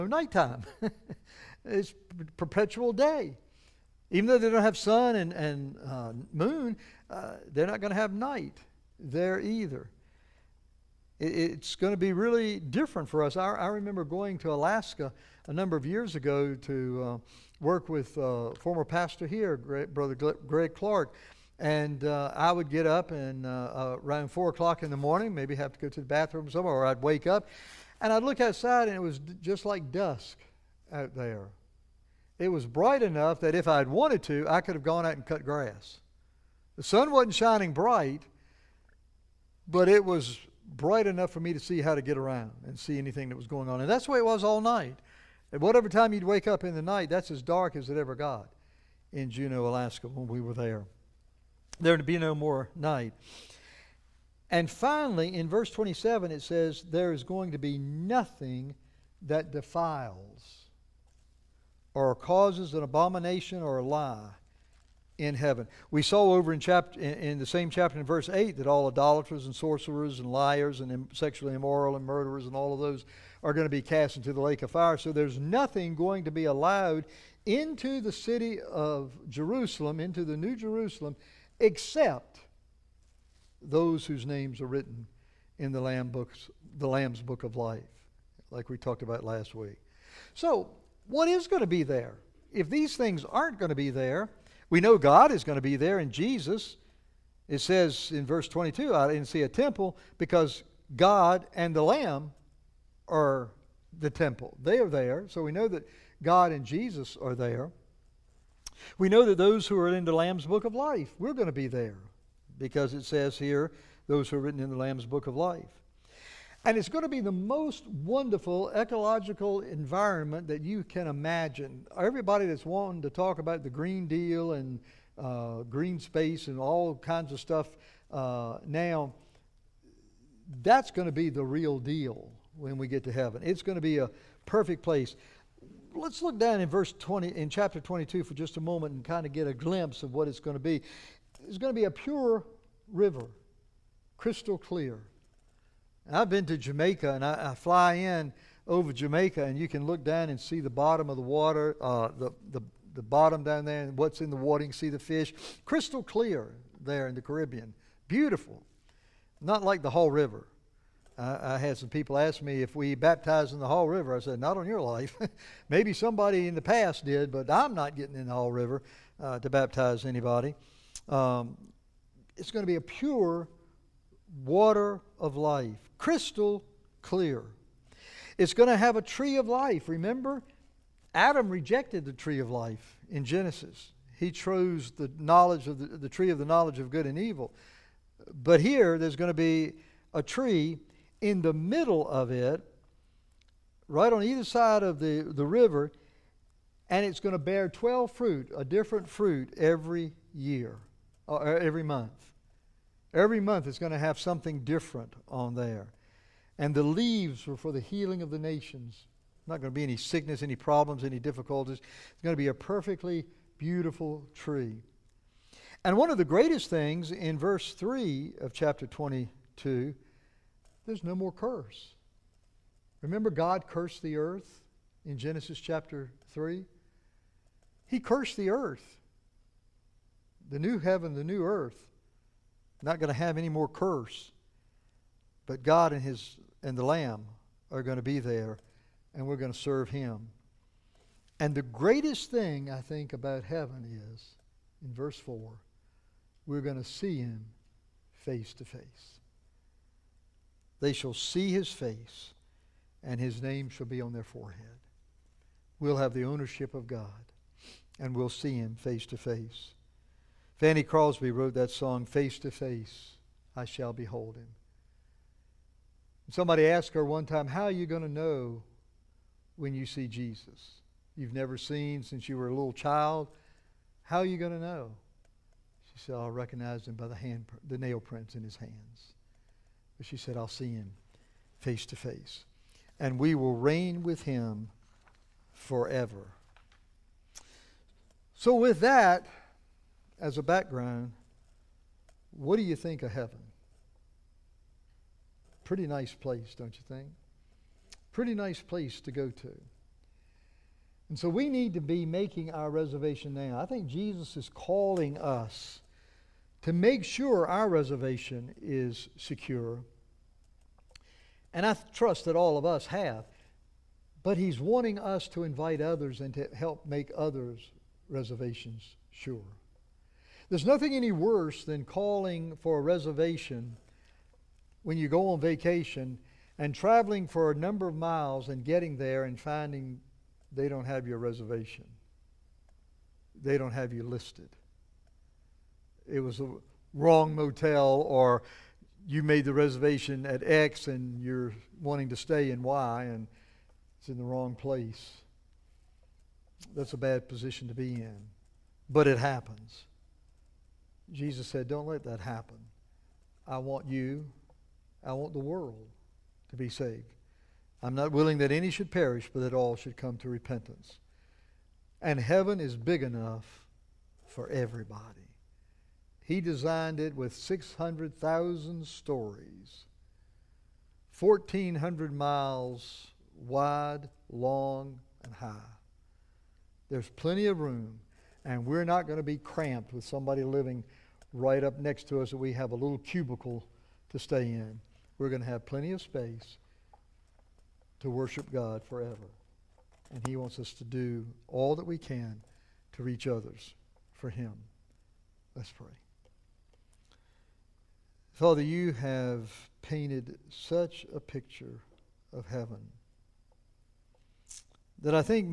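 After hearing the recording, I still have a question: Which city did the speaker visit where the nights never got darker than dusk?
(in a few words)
Juneau, Alaska.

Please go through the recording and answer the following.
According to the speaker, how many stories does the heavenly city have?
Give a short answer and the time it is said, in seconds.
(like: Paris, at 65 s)
600,000, at 367 s.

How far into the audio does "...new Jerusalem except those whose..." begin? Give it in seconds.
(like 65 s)
80 s.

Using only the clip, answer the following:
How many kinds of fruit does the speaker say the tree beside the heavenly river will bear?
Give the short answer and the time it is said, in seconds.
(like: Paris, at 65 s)
12, at 197 s.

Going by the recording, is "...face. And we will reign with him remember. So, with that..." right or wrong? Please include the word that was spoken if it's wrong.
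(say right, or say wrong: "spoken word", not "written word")
wrong: "forever", not "remember".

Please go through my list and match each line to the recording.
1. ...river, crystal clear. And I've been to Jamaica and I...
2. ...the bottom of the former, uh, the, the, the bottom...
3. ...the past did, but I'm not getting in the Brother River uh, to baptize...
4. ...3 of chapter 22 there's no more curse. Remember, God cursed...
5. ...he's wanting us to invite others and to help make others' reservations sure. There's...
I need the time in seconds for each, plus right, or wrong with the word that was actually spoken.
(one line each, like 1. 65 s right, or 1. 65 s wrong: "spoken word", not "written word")
1. 142 s right
2. 150 s wrong: "water", not "former"
3. 166 s wrong: "Haw", not "Brother"
4. 217 s right
5. 314 s right.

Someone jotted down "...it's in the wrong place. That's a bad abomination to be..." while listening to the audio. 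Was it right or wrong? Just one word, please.
wrong.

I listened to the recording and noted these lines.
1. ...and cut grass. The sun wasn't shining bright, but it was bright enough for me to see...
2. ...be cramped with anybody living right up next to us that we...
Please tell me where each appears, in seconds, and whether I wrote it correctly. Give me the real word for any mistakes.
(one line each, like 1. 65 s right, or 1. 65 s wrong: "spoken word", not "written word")
1. 35 s right
2. 379 s wrong: "somebody", not "anybody".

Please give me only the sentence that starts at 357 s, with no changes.
I'm not willing that any should perish, but that all should come to repentance.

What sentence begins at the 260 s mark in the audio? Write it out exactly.
Fanny Crosby wrote that song, Face to Face, I Shall Behold Him.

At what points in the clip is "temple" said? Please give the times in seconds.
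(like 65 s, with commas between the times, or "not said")
99 s, 104 s.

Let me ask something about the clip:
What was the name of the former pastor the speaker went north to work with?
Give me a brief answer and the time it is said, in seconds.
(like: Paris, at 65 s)
Greg Clark, at 20 s.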